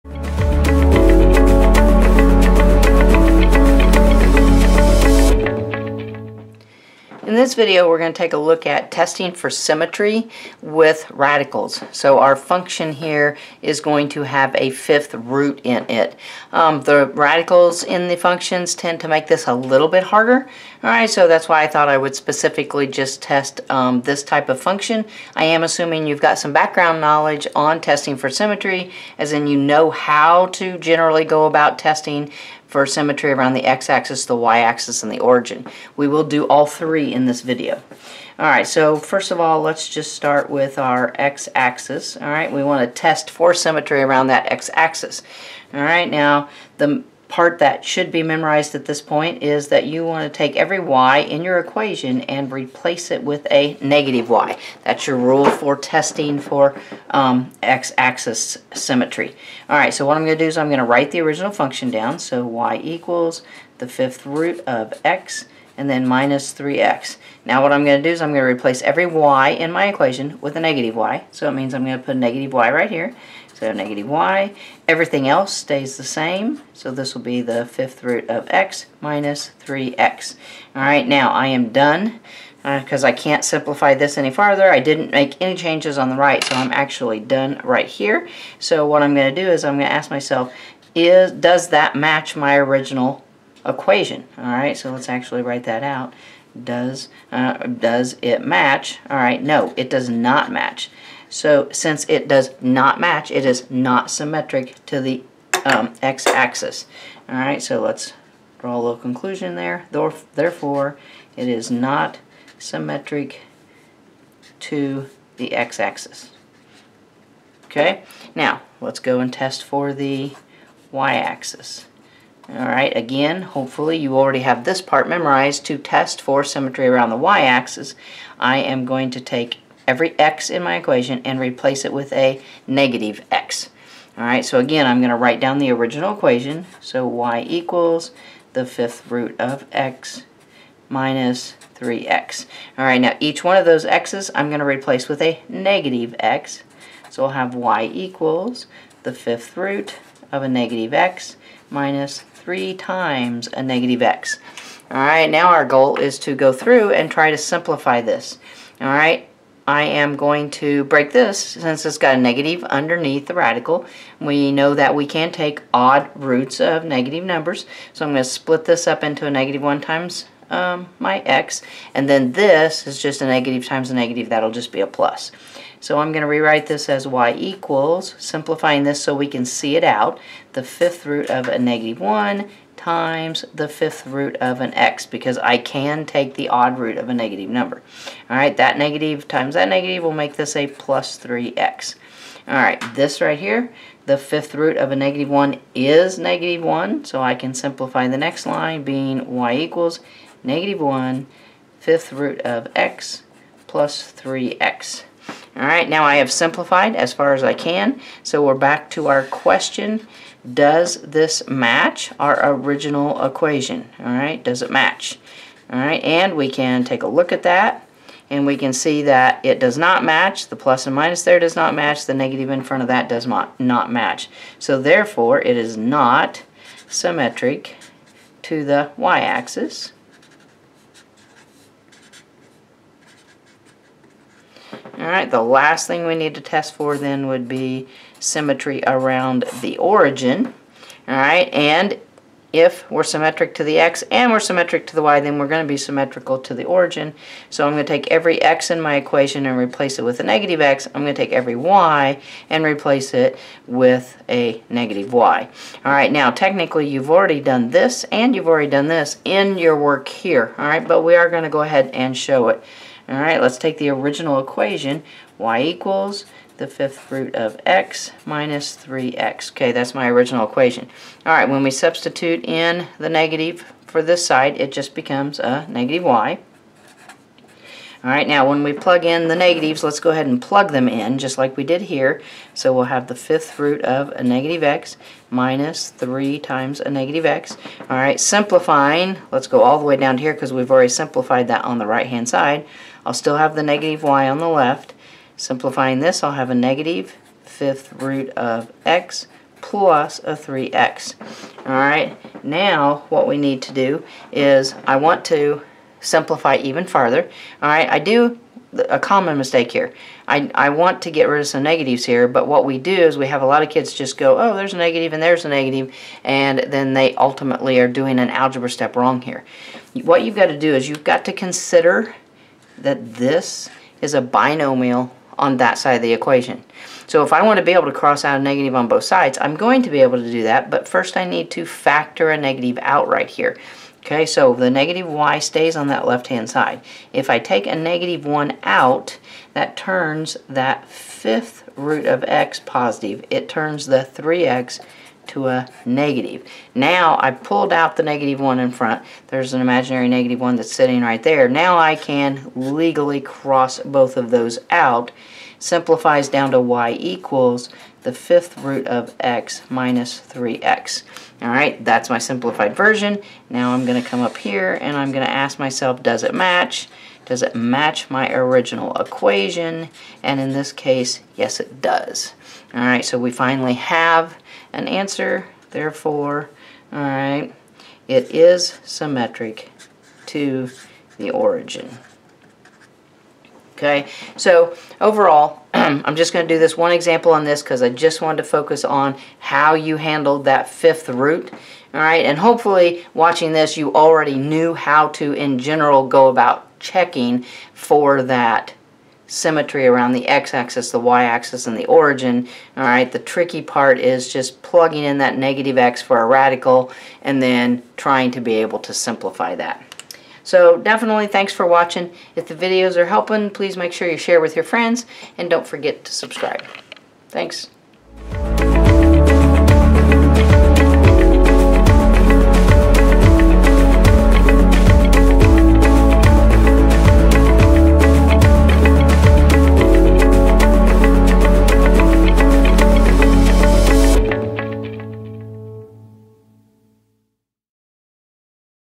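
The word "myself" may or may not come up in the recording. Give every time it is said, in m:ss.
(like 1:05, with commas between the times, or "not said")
1:30, 6:05.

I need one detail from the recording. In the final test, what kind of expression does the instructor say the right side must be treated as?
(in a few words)
binomial.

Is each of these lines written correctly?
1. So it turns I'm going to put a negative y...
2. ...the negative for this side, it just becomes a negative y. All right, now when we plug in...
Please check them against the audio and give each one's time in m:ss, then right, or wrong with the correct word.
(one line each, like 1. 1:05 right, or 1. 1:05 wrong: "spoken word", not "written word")
1. 1:11 wrong: "means", not "turns"
2. 4:32 right.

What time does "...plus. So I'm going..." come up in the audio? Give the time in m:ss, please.
2:54.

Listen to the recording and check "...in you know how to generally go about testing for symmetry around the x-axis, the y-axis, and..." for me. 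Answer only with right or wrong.
right.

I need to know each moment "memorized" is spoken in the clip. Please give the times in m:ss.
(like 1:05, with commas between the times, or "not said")
0:48, 2:05.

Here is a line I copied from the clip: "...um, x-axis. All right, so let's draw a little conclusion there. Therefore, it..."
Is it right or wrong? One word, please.
right.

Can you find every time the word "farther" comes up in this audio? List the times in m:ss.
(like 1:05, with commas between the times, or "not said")
1:24, 5:06.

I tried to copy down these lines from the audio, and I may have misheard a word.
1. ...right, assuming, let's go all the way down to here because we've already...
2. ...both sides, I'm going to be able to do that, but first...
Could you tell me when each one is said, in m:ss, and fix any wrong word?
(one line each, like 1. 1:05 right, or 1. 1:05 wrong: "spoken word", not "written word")
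1. 4:47 wrong: "simplifying", not "assuming"
2. 5:28 right.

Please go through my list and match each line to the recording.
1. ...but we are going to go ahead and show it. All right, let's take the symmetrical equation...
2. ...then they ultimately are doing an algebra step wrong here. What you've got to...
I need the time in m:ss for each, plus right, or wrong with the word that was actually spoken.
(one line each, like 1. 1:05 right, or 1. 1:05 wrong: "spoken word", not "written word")
1. 4:20 wrong: "original", not "symmetrical"
2. 5:16 right.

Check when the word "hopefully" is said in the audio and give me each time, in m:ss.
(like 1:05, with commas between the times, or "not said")
2:03, 6:32.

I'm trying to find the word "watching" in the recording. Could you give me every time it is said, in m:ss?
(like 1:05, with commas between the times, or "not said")
6:33, 6:51.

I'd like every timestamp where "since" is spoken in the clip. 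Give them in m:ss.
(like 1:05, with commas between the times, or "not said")
1:41, 2:41.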